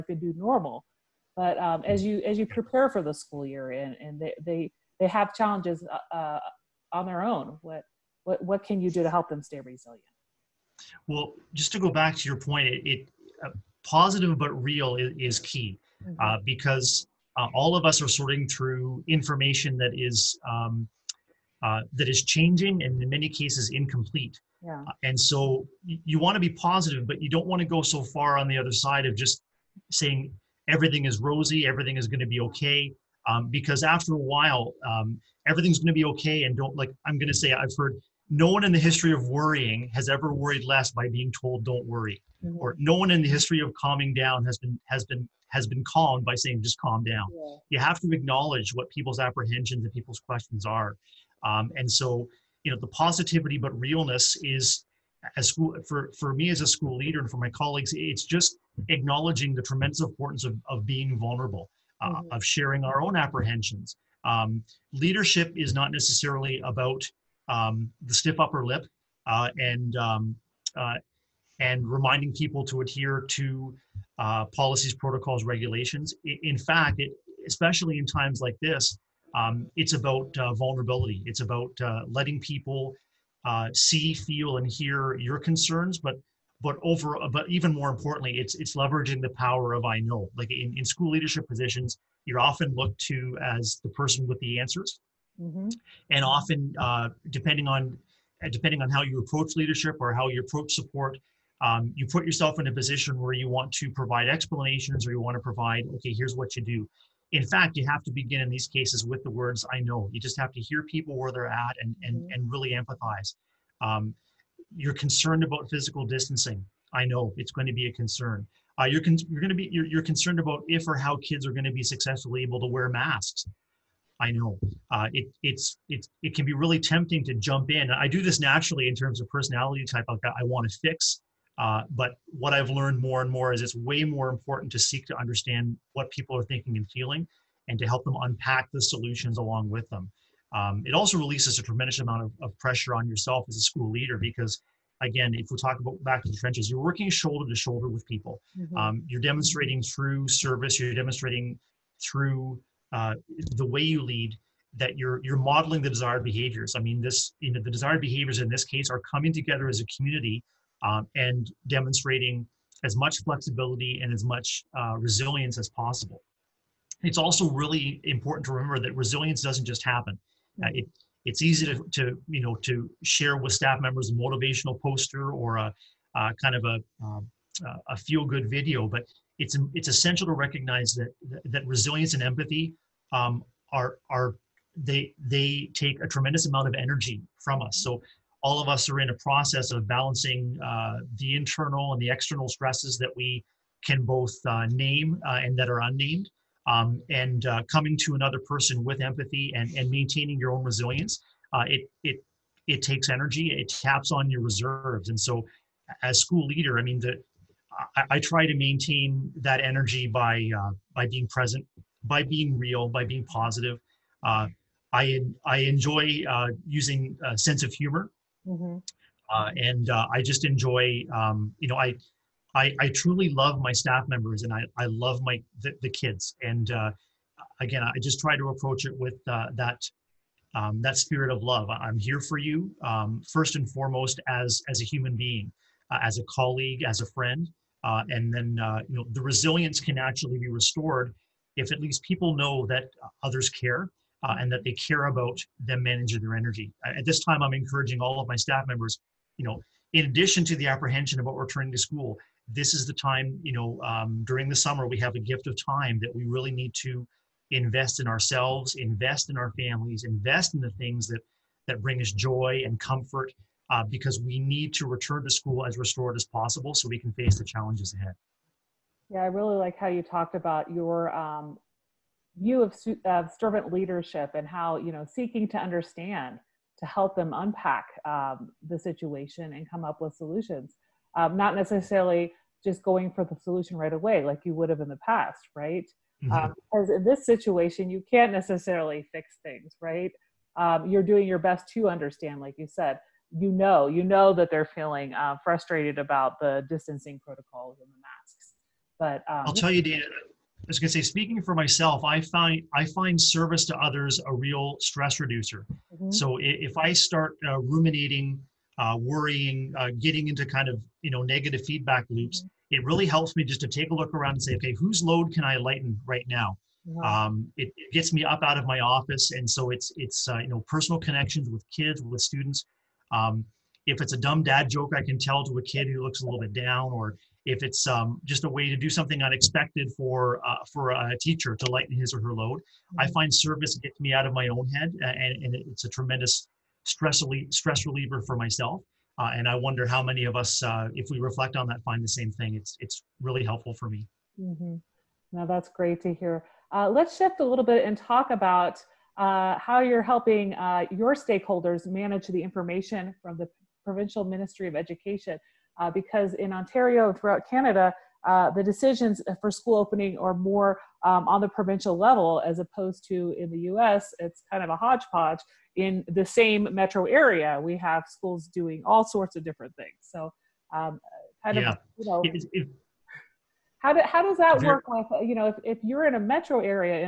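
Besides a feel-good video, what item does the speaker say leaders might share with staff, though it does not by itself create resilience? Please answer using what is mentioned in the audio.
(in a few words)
motivational poster.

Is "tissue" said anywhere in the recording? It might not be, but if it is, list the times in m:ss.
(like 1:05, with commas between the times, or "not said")
not said.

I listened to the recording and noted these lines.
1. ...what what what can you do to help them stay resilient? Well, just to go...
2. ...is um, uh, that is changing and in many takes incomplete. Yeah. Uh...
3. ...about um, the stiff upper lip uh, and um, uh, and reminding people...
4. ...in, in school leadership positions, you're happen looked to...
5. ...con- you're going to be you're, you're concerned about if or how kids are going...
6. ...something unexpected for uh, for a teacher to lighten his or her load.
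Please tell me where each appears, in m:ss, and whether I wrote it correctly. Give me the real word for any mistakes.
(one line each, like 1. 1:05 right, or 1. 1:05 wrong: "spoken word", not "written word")
1. 0:07 right
2. 0:19 wrong: "cases", not "takes"
3. 1:06 right
4. 1:30 wrong: "often", not "happen"
5. 1:59 right
6. 5:28 right.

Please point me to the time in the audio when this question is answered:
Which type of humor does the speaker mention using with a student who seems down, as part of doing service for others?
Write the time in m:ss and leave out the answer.
5:24.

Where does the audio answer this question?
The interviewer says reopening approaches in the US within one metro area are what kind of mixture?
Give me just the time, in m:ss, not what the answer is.
6:04.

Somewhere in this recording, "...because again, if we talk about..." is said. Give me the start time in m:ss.
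2:24.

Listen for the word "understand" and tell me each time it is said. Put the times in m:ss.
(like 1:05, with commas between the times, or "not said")
2:15, 4:35, 4:51.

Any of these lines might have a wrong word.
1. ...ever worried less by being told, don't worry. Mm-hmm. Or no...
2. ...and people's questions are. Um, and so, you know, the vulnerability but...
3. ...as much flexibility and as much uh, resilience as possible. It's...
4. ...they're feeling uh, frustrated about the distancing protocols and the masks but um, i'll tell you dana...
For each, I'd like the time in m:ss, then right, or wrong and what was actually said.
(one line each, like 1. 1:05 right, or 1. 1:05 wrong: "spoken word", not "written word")
1. 0:40 right
2. 0:49 wrong: "positivity", not "vulnerability"
3. 2:42 right
4. 4:54 right.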